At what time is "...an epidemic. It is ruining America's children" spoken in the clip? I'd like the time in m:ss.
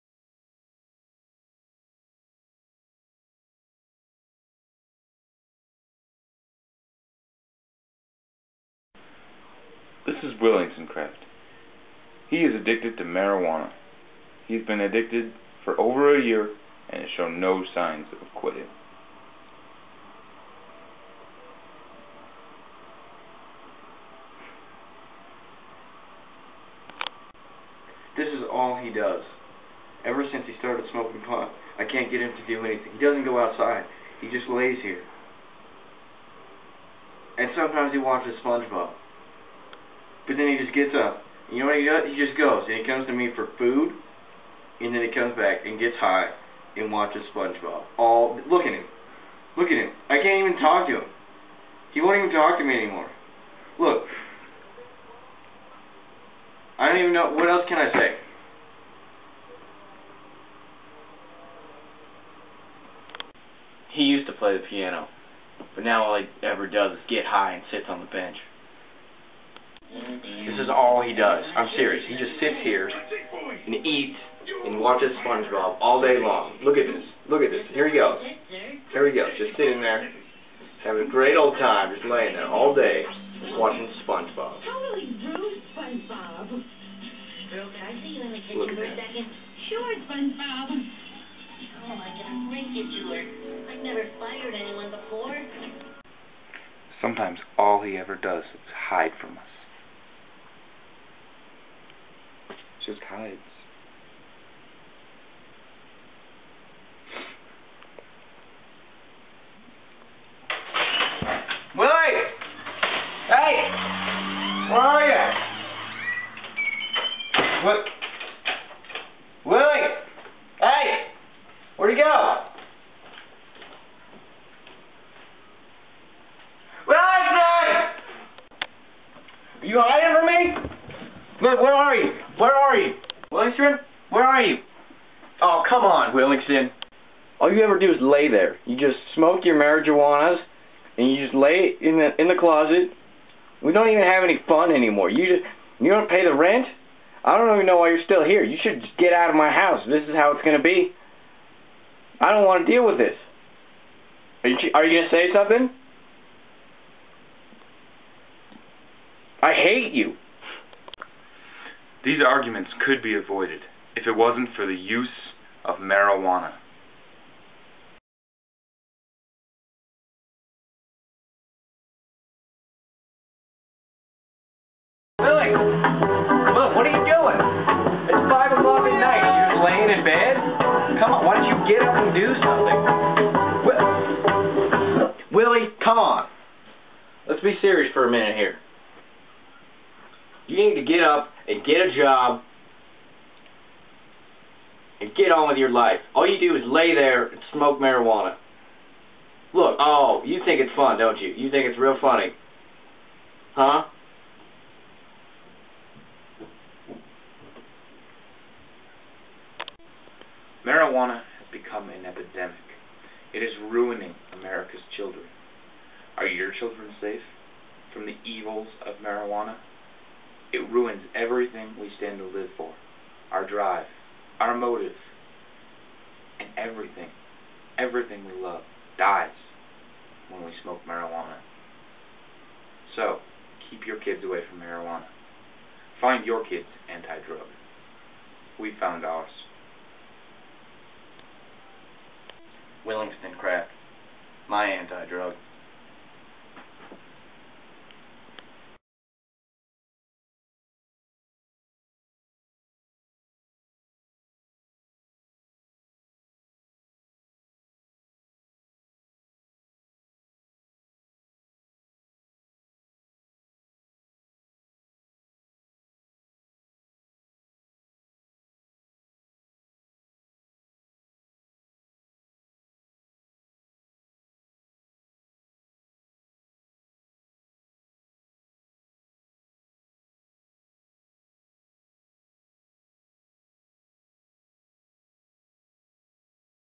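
3:31.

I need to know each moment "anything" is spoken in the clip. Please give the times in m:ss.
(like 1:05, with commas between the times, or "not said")
0:32.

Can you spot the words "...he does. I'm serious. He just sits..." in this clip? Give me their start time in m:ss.
1:11.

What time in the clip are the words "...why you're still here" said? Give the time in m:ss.
2:27.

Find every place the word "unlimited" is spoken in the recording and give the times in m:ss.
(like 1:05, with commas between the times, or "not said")
not said.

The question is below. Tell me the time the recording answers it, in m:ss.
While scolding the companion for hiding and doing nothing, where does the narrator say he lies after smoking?
2:22.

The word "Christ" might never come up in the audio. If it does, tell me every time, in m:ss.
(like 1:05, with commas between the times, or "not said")
not said.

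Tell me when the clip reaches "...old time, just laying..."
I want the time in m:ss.
1:21.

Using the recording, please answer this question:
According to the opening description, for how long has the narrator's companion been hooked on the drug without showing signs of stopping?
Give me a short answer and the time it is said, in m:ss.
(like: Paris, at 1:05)
over a year, at 0:15.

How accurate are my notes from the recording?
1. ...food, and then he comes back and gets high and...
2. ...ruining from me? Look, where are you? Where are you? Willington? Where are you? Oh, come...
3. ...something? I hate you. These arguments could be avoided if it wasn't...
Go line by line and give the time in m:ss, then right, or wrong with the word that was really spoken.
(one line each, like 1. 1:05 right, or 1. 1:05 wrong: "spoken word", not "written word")
1. 0:43 right
2. 2:09 wrong: "hiding", not "ruining"
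3. 2:35 right.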